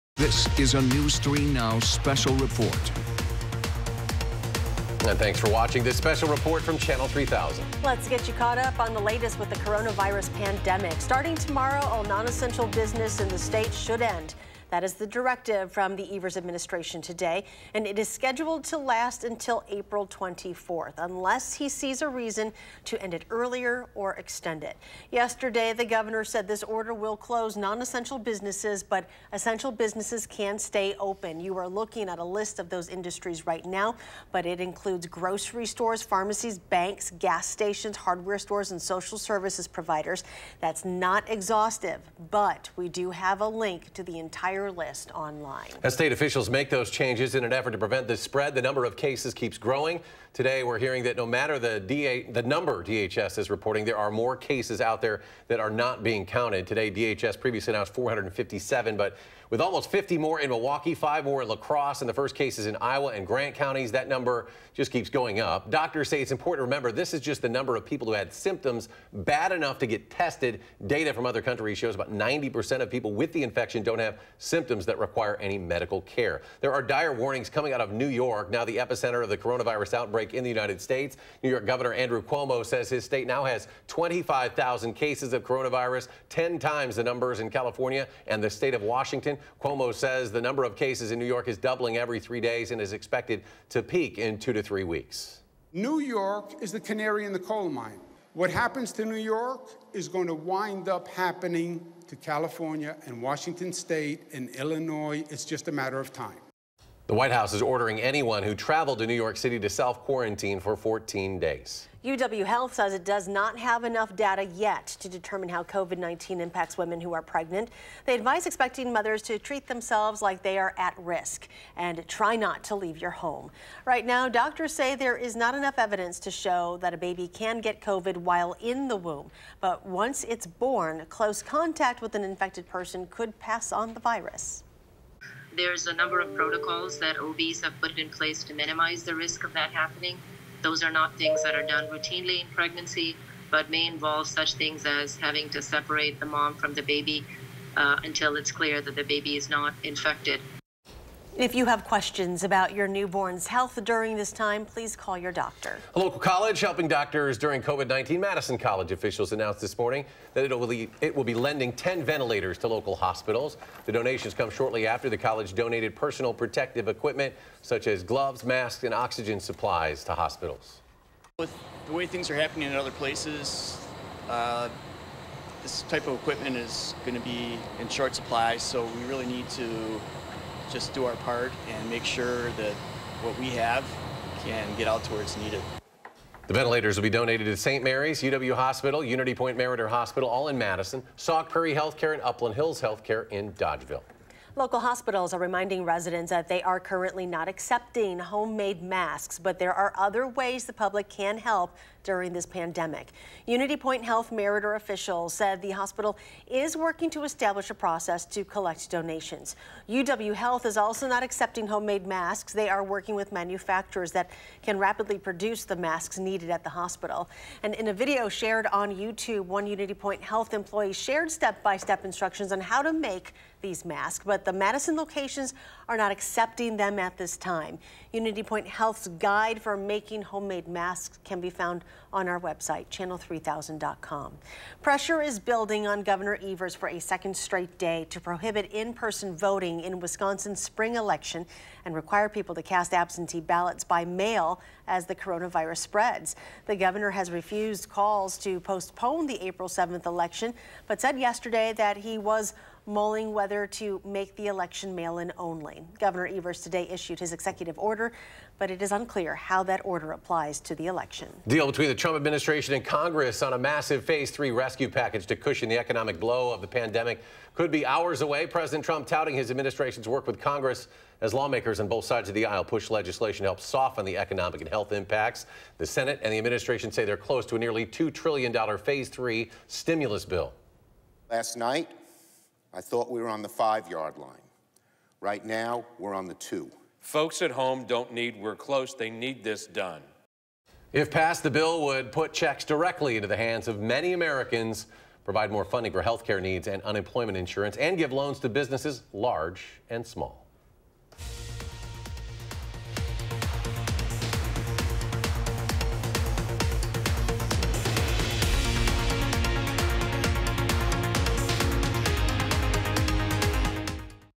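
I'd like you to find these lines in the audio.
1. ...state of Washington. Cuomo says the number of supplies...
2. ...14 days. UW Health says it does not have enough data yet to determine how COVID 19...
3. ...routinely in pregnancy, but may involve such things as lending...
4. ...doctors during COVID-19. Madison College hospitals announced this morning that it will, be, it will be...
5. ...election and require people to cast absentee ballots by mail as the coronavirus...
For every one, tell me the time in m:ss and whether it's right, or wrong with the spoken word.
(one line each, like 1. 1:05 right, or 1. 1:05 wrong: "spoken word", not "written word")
1. 1:28 wrong: "cases", not "supplies"
2. 1:50 right
3. 2:21 wrong: "having", not "lending"
4. 2:36 wrong: "officials", not "hospitals"
5. 4:00 right.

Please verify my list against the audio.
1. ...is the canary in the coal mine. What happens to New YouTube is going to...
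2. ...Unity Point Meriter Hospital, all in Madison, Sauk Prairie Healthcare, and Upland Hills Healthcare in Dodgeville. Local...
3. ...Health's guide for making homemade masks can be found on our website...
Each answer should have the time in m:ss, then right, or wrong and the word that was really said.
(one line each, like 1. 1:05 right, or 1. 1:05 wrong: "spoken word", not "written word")
1. 1:36 wrong: "York", not "YouTube"
2. 3:09 right
3. 3:48 right.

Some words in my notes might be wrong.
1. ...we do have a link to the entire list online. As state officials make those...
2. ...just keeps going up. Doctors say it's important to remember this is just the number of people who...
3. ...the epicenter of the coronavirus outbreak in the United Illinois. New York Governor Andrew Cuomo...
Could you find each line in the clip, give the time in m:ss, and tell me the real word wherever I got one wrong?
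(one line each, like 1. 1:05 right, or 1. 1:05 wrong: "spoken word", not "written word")
1. 0:42 right
2. 1:04 right
3. 1:18 wrong: "States", not "Illinois".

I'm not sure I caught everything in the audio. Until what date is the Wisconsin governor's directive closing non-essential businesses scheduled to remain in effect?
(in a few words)
April 24th.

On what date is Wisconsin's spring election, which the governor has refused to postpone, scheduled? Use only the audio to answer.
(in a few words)
April 7th.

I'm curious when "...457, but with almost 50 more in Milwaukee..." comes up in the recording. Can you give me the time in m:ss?
0:57.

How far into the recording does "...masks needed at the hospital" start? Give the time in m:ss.
3:35.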